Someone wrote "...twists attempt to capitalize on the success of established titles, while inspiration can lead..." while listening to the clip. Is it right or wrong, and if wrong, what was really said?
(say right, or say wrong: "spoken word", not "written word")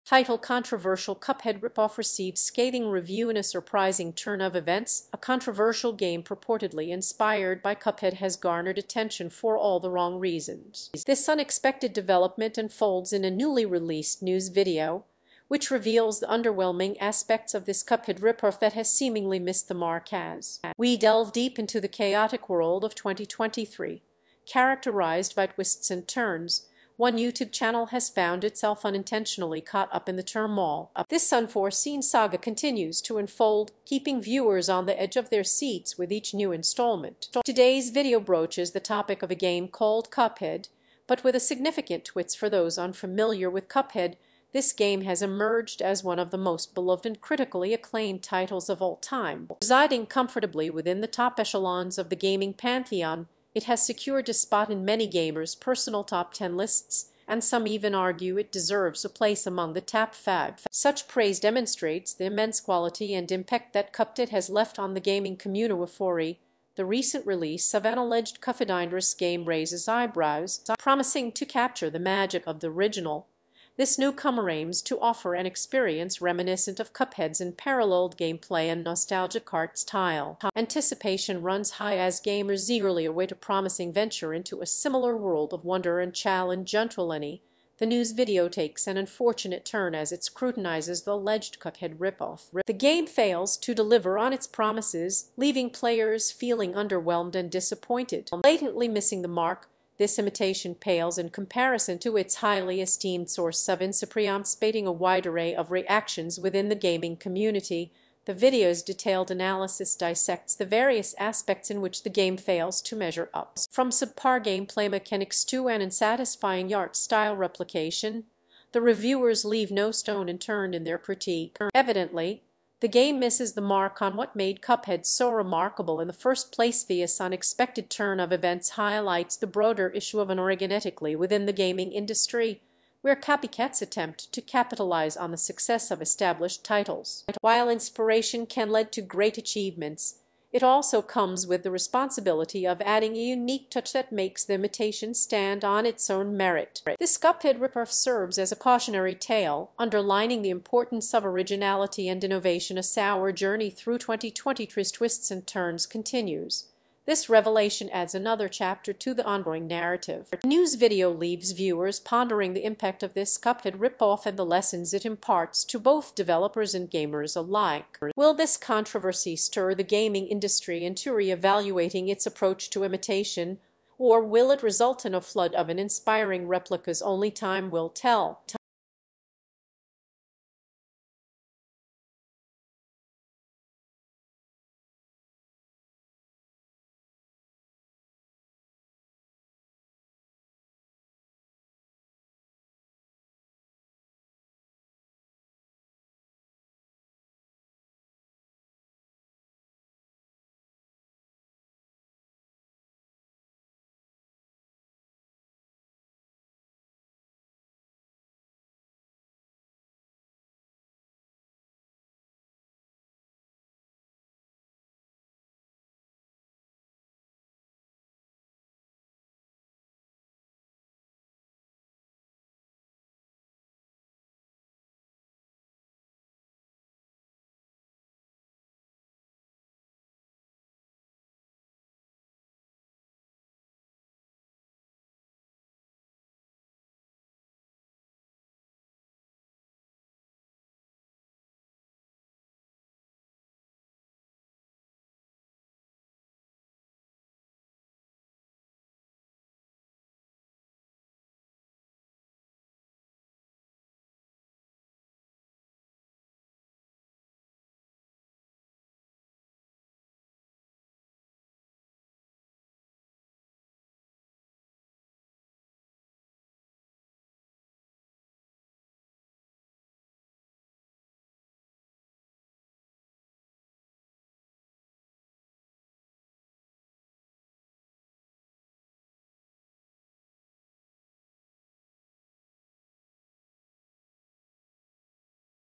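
wrong: "copycats", not "twists".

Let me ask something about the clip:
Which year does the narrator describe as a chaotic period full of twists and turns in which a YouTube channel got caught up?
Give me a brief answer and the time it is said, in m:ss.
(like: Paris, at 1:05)
2023, at 0:22.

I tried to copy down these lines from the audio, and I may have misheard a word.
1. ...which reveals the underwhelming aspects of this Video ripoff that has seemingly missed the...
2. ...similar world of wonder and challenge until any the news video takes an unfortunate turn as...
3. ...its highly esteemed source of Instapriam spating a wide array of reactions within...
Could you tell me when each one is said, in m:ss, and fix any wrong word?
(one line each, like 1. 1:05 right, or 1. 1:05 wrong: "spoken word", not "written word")
1. 0:15 wrong: "Cuphead", not "Video"
2. 1:24 right
3. 1:42 right.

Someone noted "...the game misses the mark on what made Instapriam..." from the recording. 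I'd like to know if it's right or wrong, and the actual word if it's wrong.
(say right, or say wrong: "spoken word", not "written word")
wrong: "Cuphead", not "Instapriam".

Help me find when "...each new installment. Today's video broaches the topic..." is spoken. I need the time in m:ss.
0:36.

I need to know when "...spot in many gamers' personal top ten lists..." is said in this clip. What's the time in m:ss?
0:54.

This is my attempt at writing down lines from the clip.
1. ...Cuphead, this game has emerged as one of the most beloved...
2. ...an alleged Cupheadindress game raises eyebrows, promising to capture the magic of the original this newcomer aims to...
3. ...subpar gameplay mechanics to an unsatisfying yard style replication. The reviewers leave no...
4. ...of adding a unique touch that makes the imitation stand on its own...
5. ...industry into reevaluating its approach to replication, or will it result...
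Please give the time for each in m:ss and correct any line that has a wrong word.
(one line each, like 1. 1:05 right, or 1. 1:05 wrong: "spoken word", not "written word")
1. 0:43 right
2. 1:07 right
3. 1:53 right
4. 2:22 right
5. 2:50 wrong: "imitation", not "replication".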